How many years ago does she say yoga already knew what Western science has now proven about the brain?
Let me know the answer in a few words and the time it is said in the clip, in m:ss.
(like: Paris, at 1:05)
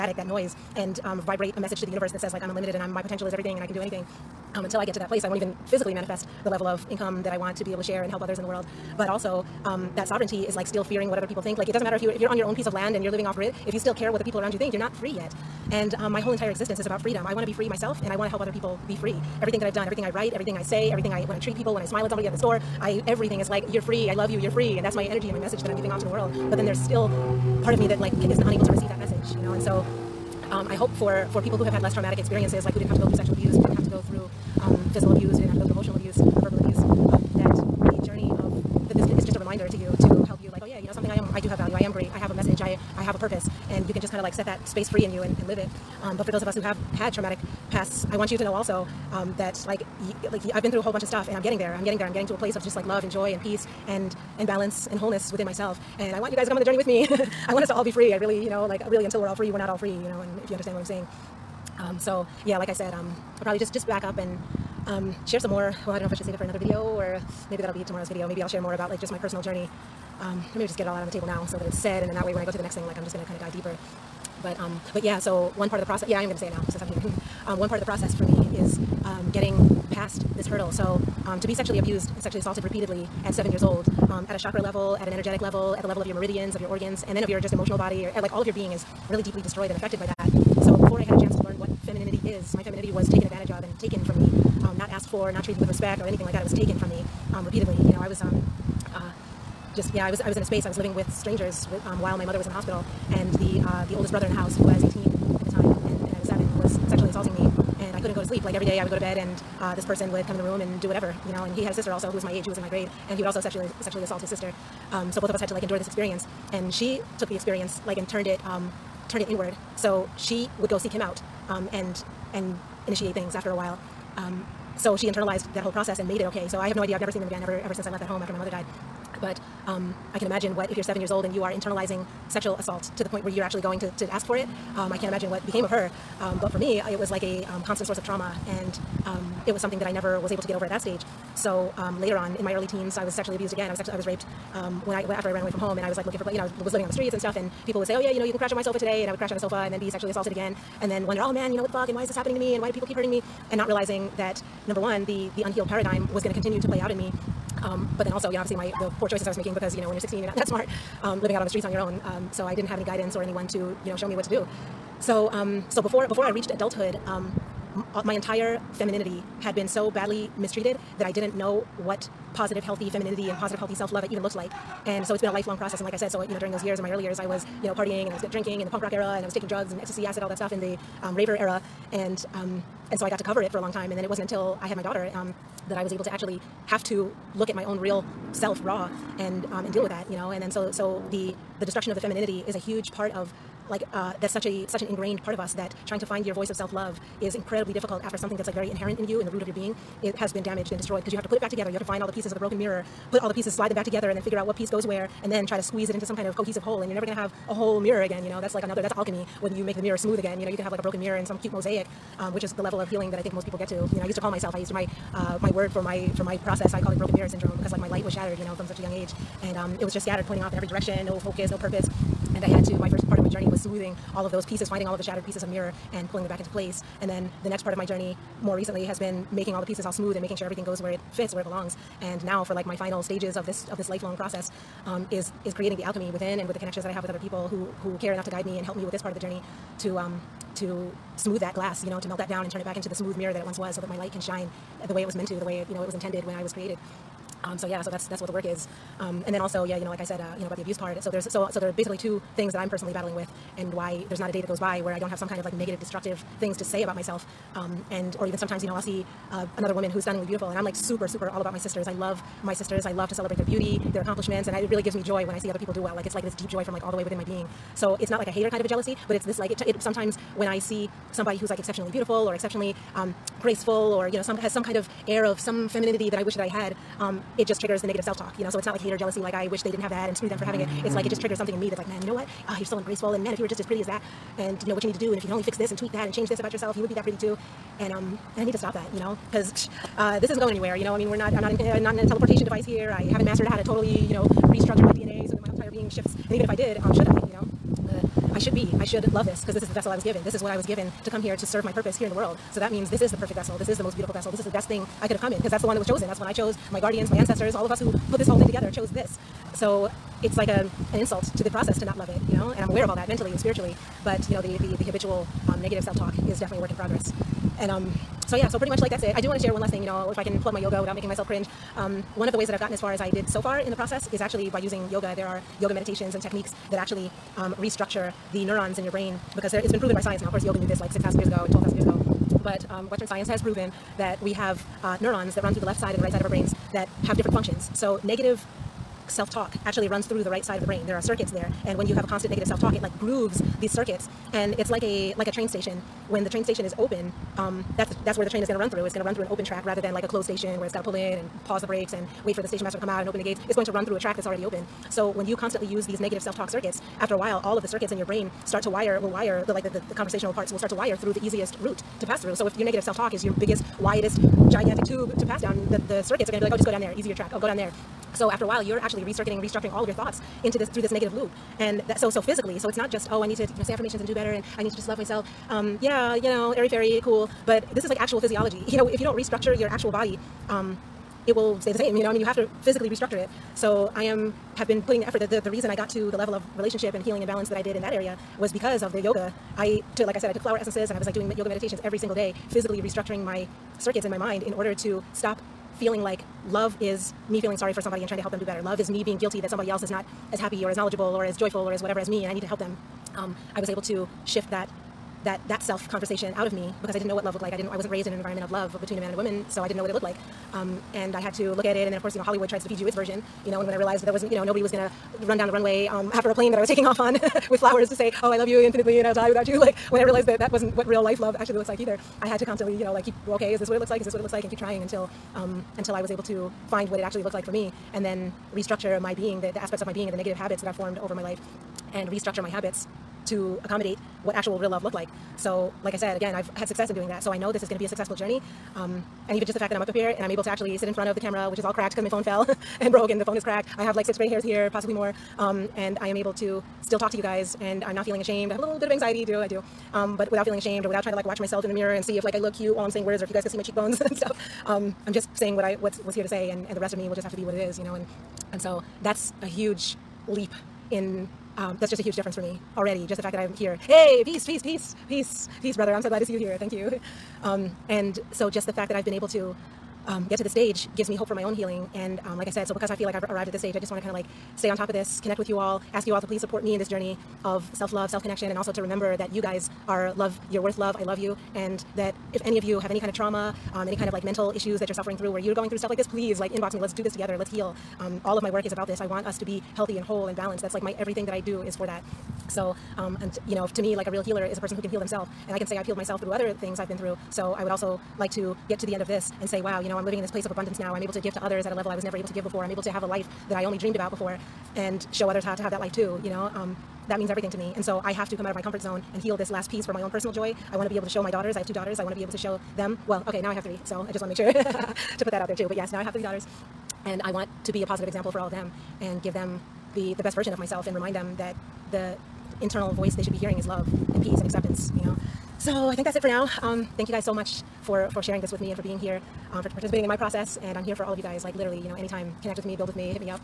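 6,000, at 5:30.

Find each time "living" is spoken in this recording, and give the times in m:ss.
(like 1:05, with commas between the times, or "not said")
0:13, 1:40, 2:26, 2:41, 8:20.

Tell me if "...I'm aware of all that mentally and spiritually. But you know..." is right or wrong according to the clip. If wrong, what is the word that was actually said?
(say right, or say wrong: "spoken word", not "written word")
right.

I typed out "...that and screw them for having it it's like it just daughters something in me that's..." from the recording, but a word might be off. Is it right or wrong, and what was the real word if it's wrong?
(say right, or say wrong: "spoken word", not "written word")
wrong: "triggers", not "daughters".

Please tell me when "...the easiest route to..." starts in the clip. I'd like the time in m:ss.
6:01.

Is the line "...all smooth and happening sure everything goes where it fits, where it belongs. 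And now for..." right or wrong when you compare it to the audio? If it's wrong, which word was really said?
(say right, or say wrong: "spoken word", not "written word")
wrong: "making", not "happening".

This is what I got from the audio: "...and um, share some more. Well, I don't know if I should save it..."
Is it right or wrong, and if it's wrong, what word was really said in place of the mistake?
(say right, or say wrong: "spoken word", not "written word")
right.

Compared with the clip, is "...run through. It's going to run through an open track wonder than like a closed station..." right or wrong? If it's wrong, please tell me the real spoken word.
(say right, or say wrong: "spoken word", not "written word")
wrong: "rather", not "wonder".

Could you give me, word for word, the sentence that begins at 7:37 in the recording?
And and so that's a huge leap in um, that's just a huge difference for me already.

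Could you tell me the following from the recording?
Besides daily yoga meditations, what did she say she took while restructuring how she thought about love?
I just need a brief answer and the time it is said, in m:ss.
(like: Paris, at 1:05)
flower essences, at 6:30.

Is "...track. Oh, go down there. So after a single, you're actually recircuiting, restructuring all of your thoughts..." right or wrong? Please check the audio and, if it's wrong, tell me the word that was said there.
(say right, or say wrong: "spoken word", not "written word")
wrong: "while", not "single".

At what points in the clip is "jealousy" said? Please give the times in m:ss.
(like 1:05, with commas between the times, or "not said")
4:28, 4:38.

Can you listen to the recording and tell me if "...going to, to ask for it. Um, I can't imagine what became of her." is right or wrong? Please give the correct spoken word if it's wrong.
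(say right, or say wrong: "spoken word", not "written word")
right.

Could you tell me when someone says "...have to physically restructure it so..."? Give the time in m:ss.
6:22.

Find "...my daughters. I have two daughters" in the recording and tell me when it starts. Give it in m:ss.
8:31.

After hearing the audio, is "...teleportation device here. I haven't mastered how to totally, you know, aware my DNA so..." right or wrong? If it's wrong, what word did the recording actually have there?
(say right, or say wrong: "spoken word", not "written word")
wrong: "restructure", not "aware".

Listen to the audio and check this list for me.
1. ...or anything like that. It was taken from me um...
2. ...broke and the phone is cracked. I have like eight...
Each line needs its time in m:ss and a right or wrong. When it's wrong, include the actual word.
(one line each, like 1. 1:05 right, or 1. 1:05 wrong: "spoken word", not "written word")
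1. 1:36 right
2. 7:22 wrong: "six", not "eight".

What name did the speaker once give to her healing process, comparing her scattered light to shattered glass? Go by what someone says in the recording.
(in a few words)
broken mirror syndrome.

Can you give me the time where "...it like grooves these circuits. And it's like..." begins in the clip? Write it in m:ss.
5:42.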